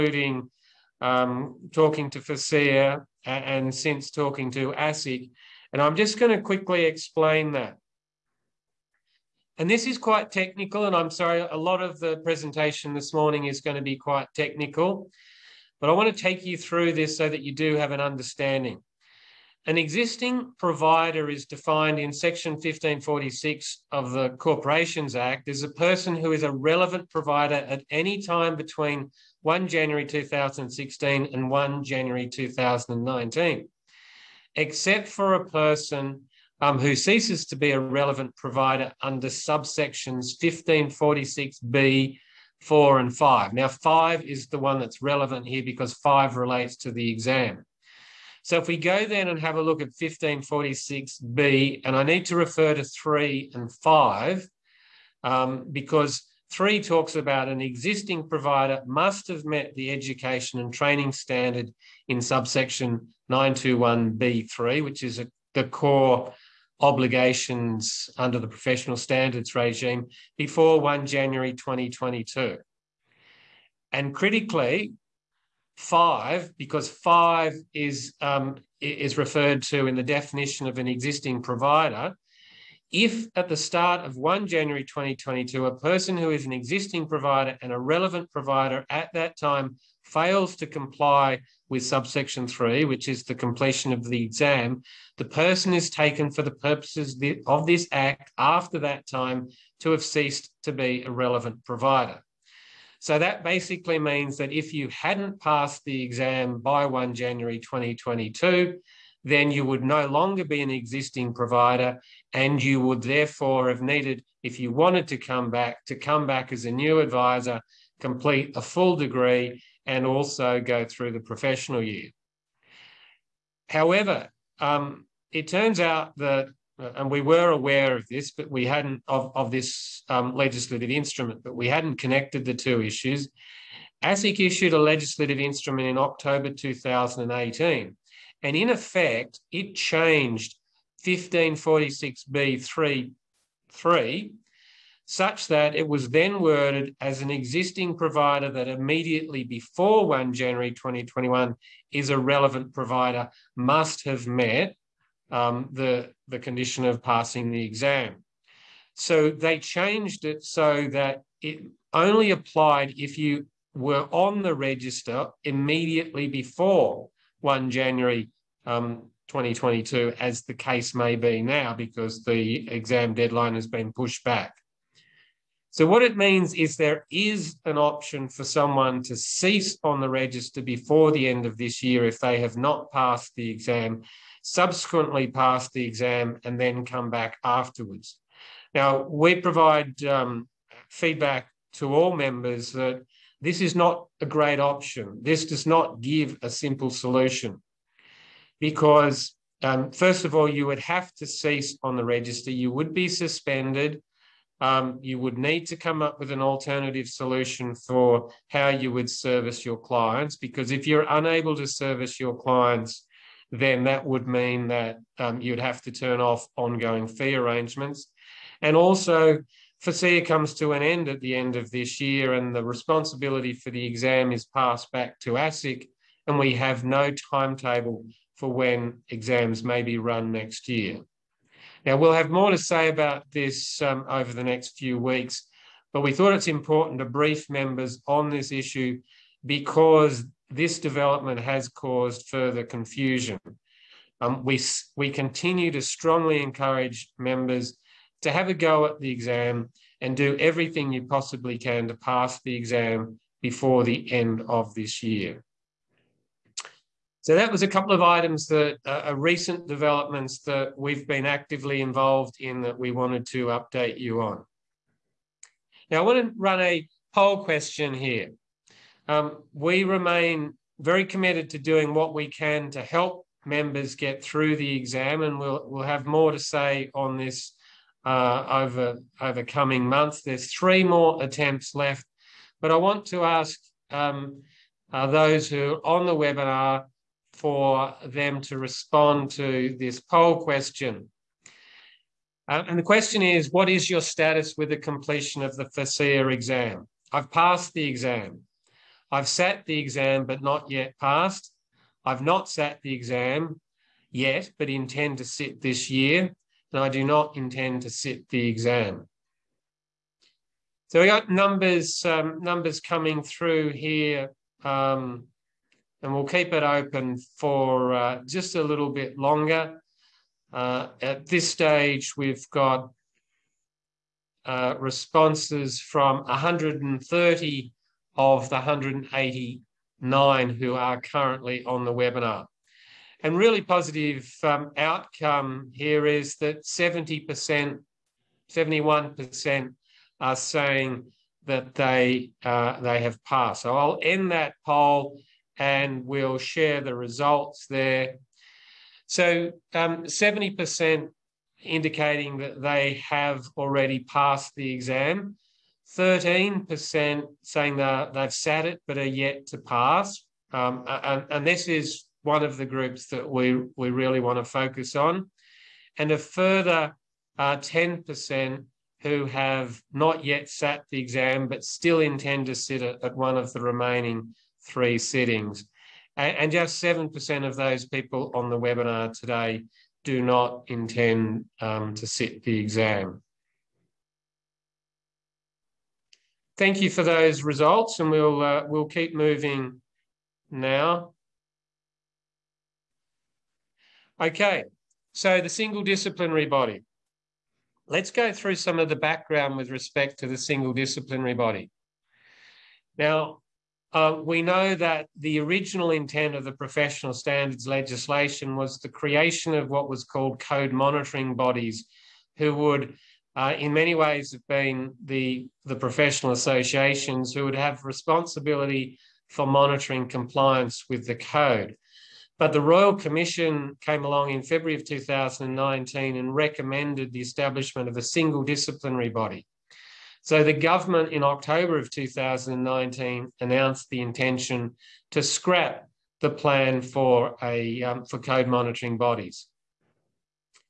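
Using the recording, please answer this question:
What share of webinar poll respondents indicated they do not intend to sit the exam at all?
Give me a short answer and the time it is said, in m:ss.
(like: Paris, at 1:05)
7%, at 6:16.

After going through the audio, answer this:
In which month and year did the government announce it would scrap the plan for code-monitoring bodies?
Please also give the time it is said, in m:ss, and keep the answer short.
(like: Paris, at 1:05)
October 2019, at 7:11.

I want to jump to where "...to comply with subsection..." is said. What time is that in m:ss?
1:30.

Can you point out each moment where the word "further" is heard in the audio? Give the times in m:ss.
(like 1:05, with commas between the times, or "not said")
4:02, 6:06.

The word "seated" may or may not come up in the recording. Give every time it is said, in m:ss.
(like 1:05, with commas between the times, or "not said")
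not said.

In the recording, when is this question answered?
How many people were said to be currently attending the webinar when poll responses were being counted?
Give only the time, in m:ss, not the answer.
5:28.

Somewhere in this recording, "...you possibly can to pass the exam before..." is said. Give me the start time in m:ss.
4:10.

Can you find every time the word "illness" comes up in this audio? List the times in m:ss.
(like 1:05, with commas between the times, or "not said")
not said.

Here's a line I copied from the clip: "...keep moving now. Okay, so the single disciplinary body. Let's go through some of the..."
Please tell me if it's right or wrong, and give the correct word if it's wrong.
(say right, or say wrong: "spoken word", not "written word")
right.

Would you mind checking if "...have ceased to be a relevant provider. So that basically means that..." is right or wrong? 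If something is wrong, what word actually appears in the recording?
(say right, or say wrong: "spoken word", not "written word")
right.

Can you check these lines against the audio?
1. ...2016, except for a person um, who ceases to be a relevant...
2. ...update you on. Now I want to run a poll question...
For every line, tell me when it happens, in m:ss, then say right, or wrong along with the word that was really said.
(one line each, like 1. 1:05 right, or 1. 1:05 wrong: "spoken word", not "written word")
1. 0:32 wrong: "2019", not "2016"
2. 4:23 right.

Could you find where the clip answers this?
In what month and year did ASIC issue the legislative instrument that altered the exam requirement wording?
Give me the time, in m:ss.
2:15.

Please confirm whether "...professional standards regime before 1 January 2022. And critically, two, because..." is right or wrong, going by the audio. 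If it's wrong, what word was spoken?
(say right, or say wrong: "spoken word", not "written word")
wrong: "five", not "two".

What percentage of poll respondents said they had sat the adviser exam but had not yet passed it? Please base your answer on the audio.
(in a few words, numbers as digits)
13%.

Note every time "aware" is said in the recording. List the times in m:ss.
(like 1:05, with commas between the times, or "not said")
2:07.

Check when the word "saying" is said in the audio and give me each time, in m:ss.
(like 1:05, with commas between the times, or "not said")
5:40, 5:57.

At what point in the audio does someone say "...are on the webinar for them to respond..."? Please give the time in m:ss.
4:45.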